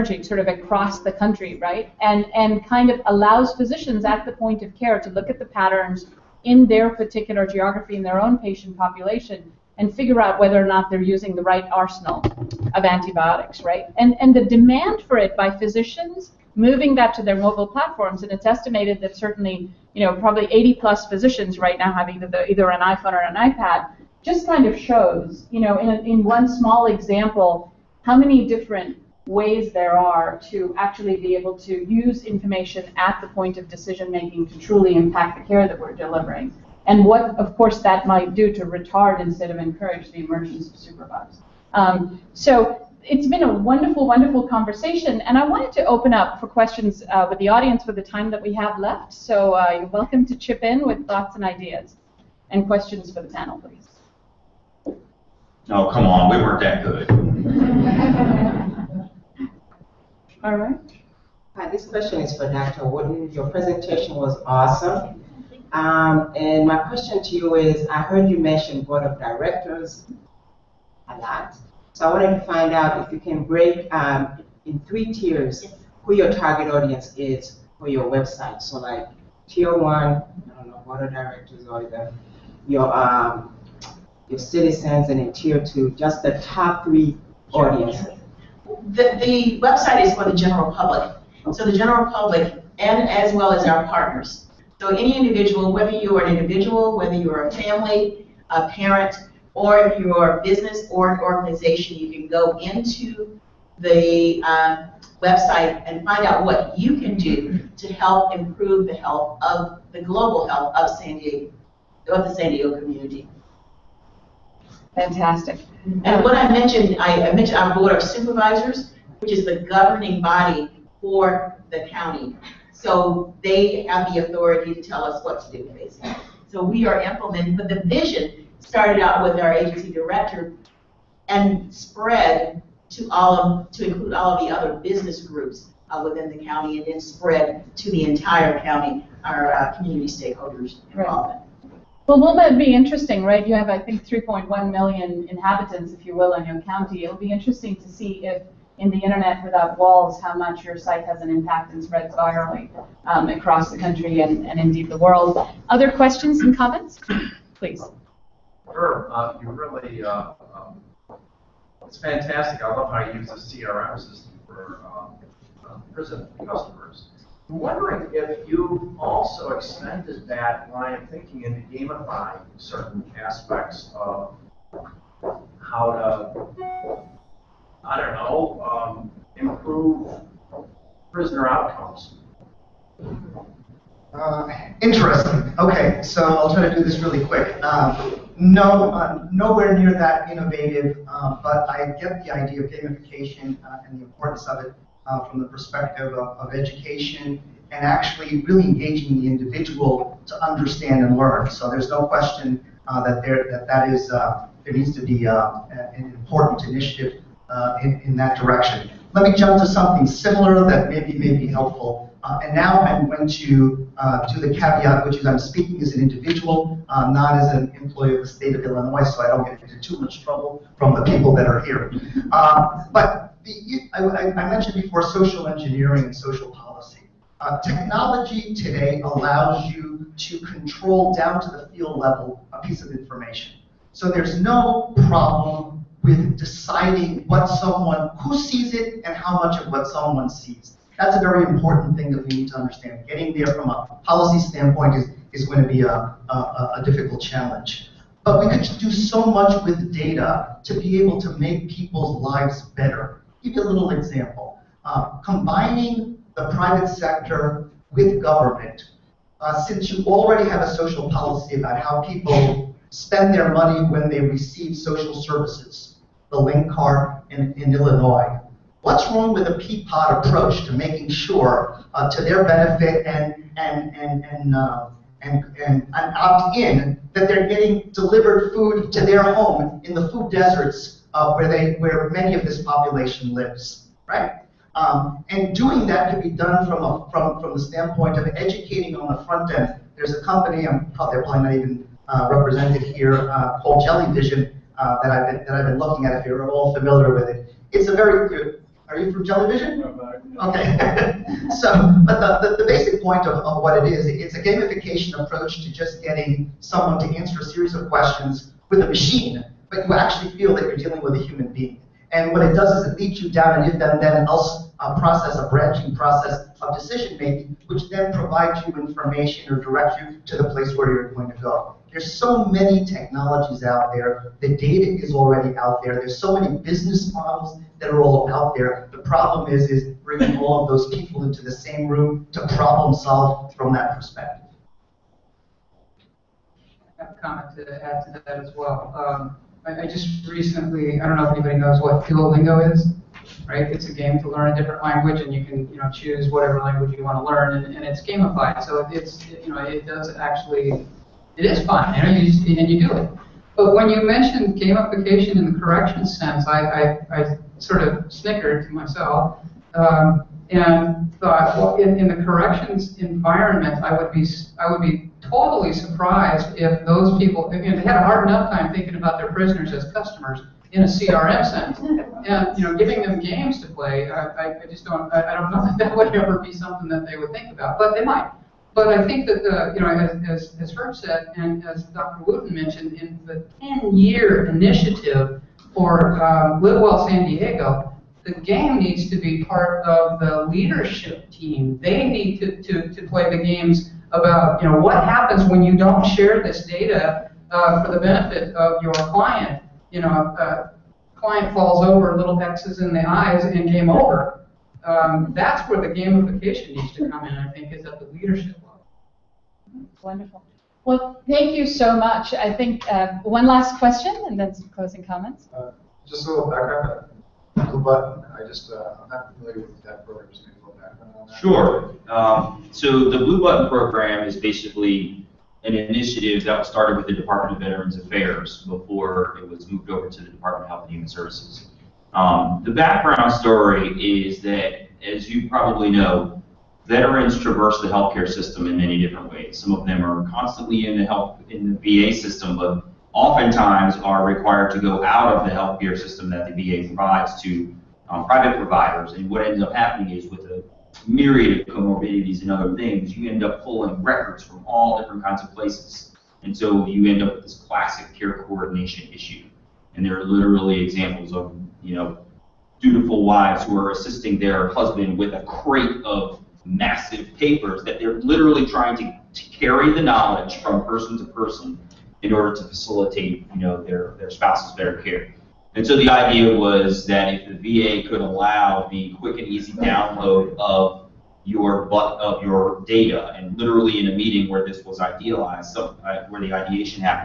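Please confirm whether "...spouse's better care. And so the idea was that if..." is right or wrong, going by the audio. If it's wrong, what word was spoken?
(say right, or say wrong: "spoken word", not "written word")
right.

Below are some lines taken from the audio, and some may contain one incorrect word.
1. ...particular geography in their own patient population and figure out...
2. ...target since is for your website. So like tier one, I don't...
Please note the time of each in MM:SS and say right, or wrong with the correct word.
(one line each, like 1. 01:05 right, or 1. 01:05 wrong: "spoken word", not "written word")
1. 00:06 right
2. 01:16 wrong: "audience", not "since".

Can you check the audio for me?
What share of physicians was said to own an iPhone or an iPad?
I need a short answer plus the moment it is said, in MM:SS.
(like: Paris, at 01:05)
80 plus, at 00:20.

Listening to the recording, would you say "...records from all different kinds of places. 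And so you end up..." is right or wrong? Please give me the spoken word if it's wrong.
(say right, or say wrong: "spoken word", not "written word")
right.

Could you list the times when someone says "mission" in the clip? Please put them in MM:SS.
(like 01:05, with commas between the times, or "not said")
not said.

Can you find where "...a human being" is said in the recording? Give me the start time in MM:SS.
05:11.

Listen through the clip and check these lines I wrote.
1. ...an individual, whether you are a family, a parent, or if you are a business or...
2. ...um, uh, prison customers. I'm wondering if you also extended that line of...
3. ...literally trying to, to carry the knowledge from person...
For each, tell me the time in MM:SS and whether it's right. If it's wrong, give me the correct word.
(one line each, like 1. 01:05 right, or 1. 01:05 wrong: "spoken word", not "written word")
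1. 01:36 right
2. 02:44 right
3. 07:48 right.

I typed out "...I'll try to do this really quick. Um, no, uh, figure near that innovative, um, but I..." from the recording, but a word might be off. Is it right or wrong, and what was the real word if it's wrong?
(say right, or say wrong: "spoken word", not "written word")
wrong: "nowhere", not "figure".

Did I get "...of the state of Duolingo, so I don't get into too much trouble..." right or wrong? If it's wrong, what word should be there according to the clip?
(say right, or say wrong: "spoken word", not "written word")
wrong: "Illinois", not "Duolingo".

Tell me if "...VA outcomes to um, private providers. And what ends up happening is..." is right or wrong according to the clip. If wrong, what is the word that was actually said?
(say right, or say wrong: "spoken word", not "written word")
wrong: "provides", not "outcomes".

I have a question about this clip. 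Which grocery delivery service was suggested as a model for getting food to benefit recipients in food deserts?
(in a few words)
Peapod.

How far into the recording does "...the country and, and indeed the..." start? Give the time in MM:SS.
02:33.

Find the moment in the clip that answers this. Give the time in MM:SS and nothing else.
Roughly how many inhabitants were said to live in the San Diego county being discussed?
02:24.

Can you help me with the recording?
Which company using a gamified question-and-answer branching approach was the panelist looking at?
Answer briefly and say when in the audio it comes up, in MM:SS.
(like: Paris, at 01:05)
Jellyvision, at 04:53.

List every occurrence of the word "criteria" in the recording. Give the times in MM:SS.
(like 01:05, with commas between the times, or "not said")
not said.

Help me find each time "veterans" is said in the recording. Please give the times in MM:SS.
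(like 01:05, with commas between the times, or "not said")
07:07, 07:16.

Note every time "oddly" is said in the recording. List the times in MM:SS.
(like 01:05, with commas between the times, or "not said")
not said.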